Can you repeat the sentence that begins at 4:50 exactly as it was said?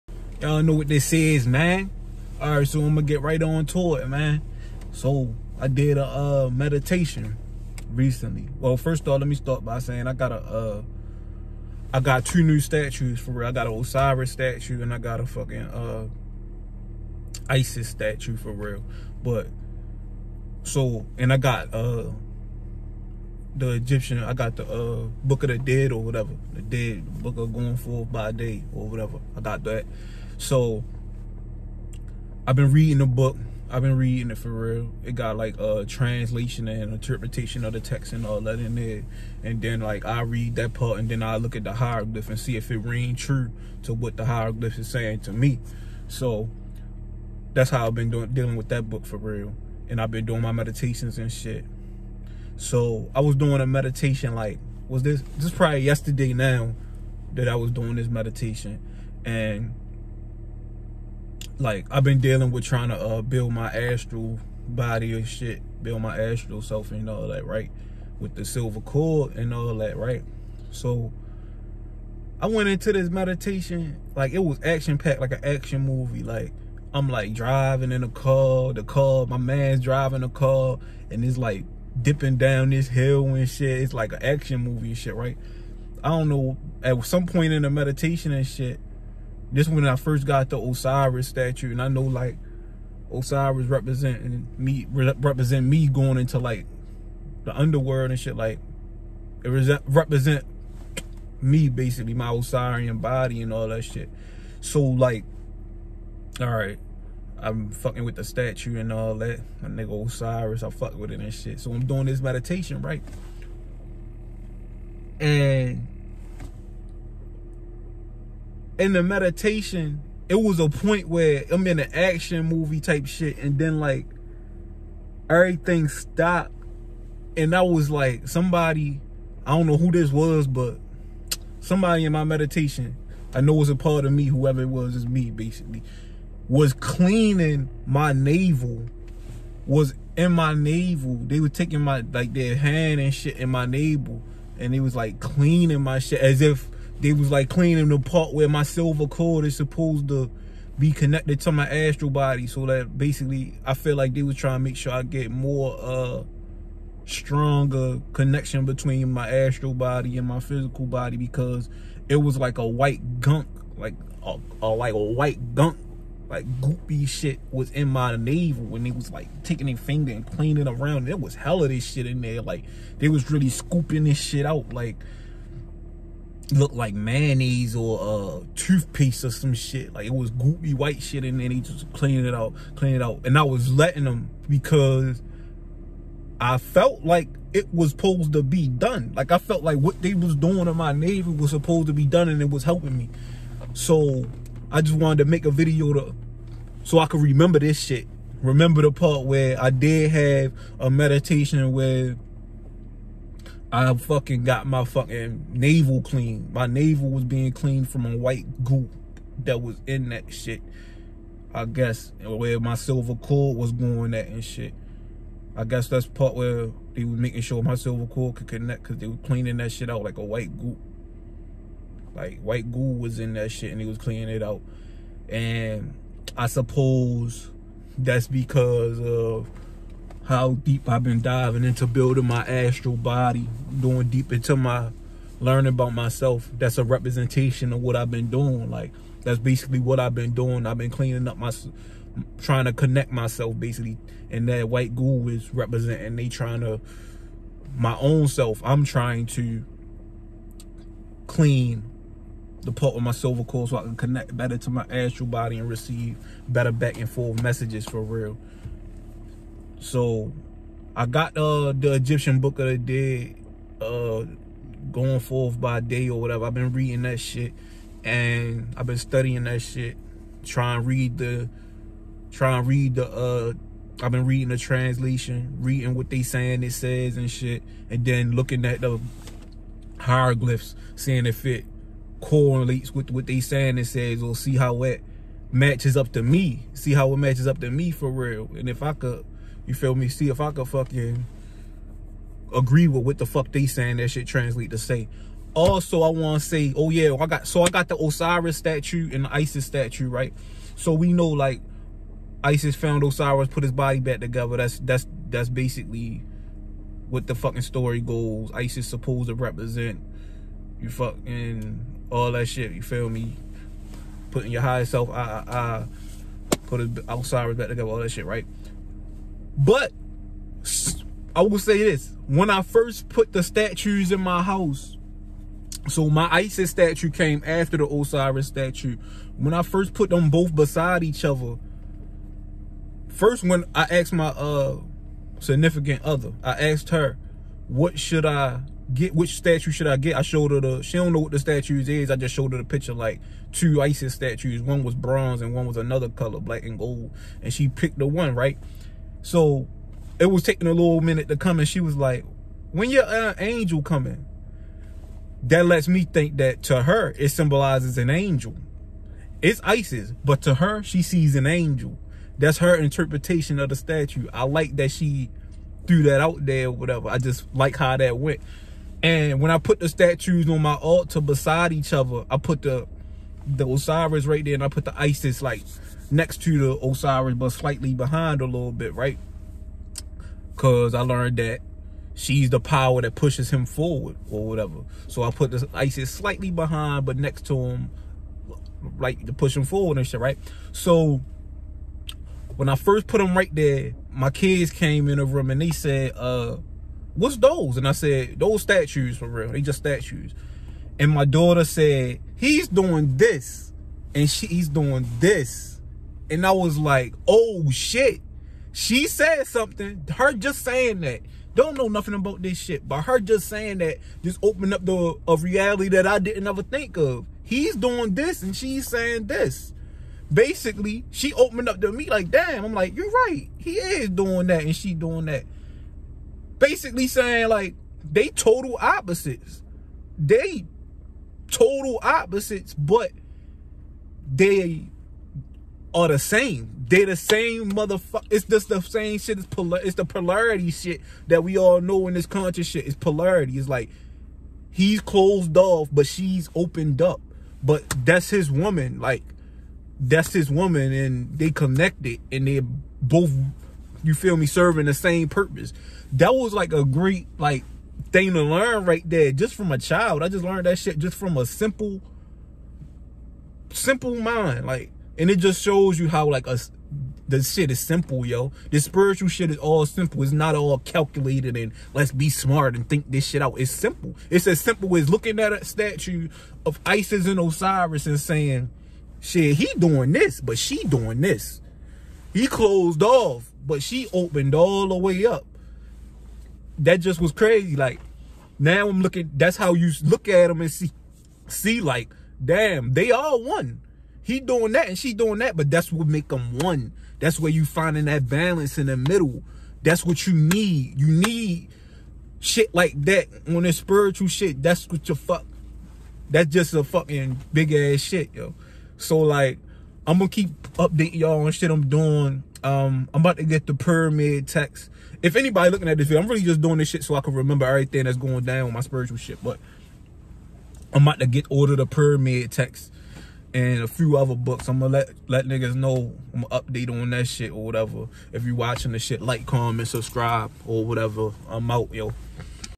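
See if I could fucking agree with what the fuck they saying that shit translate to say.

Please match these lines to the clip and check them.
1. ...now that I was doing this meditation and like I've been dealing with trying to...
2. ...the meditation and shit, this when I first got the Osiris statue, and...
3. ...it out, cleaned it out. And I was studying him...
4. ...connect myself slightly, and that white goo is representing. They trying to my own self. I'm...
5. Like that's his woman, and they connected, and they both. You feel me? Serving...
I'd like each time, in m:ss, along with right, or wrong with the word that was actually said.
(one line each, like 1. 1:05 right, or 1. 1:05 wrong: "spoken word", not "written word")
1. 0:56 right
2. 1:27 right
3. 3:02 wrong: "letting", not "studying"
4. 4:02 wrong: "basically", not "slightly"
5. 7:28 right.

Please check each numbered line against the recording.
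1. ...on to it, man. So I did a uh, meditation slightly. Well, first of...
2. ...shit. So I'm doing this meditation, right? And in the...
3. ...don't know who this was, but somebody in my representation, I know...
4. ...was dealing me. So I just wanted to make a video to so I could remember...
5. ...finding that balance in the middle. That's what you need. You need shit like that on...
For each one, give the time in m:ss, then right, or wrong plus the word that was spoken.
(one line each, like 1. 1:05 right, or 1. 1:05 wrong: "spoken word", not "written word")
1. 0:03 wrong: "recently", not "slightly"
2. 1:51 right
3. 2:09 wrong: "meditation", not "representation"
4. 3:12 wrong: "helping", not "dealing"
5. 8:17 right.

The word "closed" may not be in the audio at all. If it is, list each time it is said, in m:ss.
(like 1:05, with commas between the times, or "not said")
7:25, 8:02.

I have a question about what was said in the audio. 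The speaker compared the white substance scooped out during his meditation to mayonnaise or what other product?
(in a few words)
Toothpaste.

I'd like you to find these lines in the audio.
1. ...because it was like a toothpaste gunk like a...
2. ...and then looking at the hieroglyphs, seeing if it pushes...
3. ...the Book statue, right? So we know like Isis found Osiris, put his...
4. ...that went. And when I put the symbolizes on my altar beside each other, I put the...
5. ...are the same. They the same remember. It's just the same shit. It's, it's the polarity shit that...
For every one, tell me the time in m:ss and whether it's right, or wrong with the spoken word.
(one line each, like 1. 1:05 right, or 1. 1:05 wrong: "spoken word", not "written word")
1. 2:41 wrong: "white", not "toothpaste"
2. 4:37 wrong: "correlates", not "pushes"
3. 4:59 wrong: "Isis", not "Book"
4. 6:07 wrong: "statues", not "symbolizes"
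5. 7:15 wrong: "motherfucker", not "remember".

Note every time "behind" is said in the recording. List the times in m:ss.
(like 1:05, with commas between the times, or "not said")
6:17, 6:26.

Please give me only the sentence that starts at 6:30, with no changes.
So when I first put him right there, my kids came in the room and they said, uh, what's those?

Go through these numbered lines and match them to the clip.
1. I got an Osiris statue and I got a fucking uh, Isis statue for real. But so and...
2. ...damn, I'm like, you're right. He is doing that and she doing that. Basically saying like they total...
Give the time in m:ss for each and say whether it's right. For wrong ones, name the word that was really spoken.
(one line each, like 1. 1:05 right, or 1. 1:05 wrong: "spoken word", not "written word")
1. 0:13 right
2. 7:02 right.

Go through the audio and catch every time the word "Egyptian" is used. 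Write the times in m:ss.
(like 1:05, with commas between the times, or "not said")
0:23, 4:21.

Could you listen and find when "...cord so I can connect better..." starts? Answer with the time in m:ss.
4:13.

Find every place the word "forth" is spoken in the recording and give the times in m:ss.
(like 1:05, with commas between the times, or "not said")
0:27, 4:17, 4:25.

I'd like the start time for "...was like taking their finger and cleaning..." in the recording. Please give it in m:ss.
2:48.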